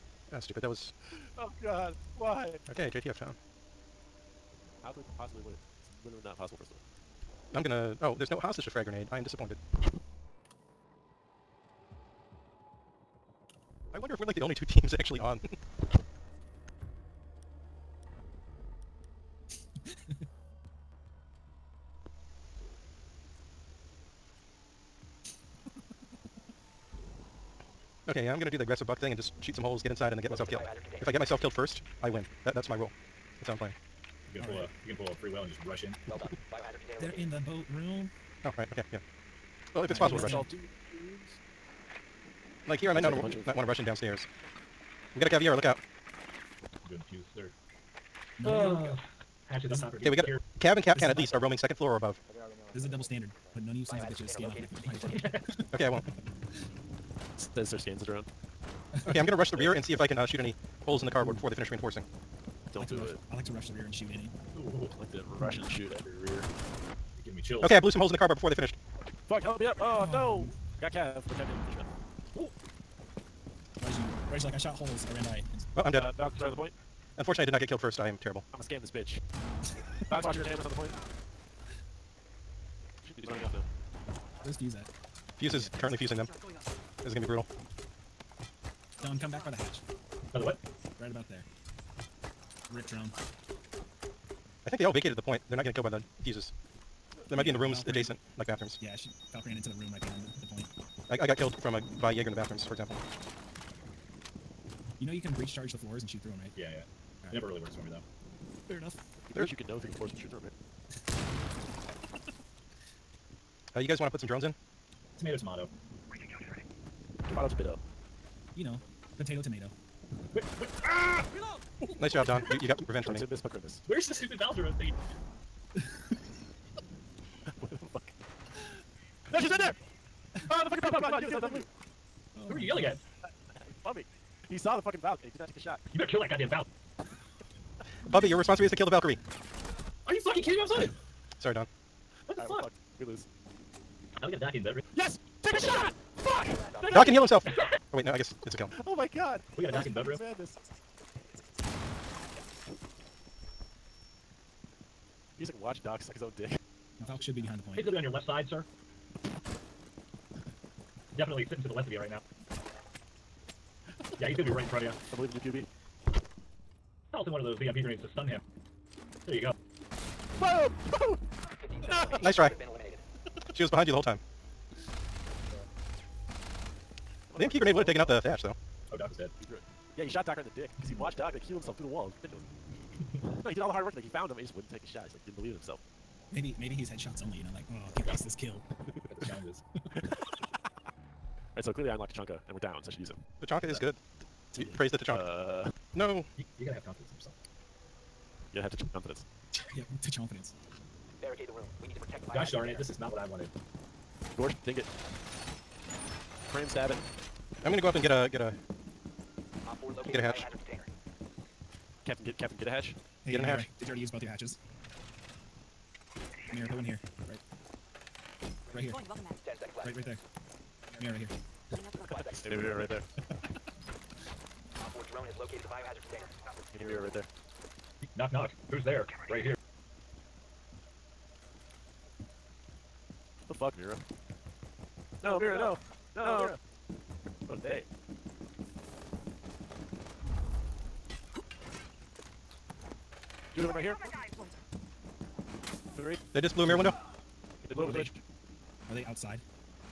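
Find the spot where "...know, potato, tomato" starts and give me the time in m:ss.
1:58.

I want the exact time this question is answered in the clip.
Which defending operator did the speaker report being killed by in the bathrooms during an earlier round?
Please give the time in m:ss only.
1:42.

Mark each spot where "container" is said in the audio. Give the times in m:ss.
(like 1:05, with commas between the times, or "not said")
0:36, 3:46.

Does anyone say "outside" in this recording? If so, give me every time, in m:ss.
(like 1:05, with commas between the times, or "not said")
4:09.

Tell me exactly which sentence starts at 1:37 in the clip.
They might yeah, be in the rooms adjacent, like bathrooms.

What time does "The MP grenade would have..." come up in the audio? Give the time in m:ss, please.
2:57.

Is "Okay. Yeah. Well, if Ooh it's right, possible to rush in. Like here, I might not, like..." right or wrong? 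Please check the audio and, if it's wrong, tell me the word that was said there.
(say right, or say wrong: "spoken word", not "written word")
wrong: "All", not "Ooh".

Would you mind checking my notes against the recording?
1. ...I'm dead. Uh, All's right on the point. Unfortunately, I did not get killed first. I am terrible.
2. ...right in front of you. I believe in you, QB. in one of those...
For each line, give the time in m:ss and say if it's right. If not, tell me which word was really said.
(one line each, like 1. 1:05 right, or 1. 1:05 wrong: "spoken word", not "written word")
1. 1:15 wrong: "Valk", not "All"
2. 2:44 right.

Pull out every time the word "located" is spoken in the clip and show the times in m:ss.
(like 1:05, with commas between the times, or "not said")
0:37, 3:45.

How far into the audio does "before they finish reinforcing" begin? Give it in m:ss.
1:01.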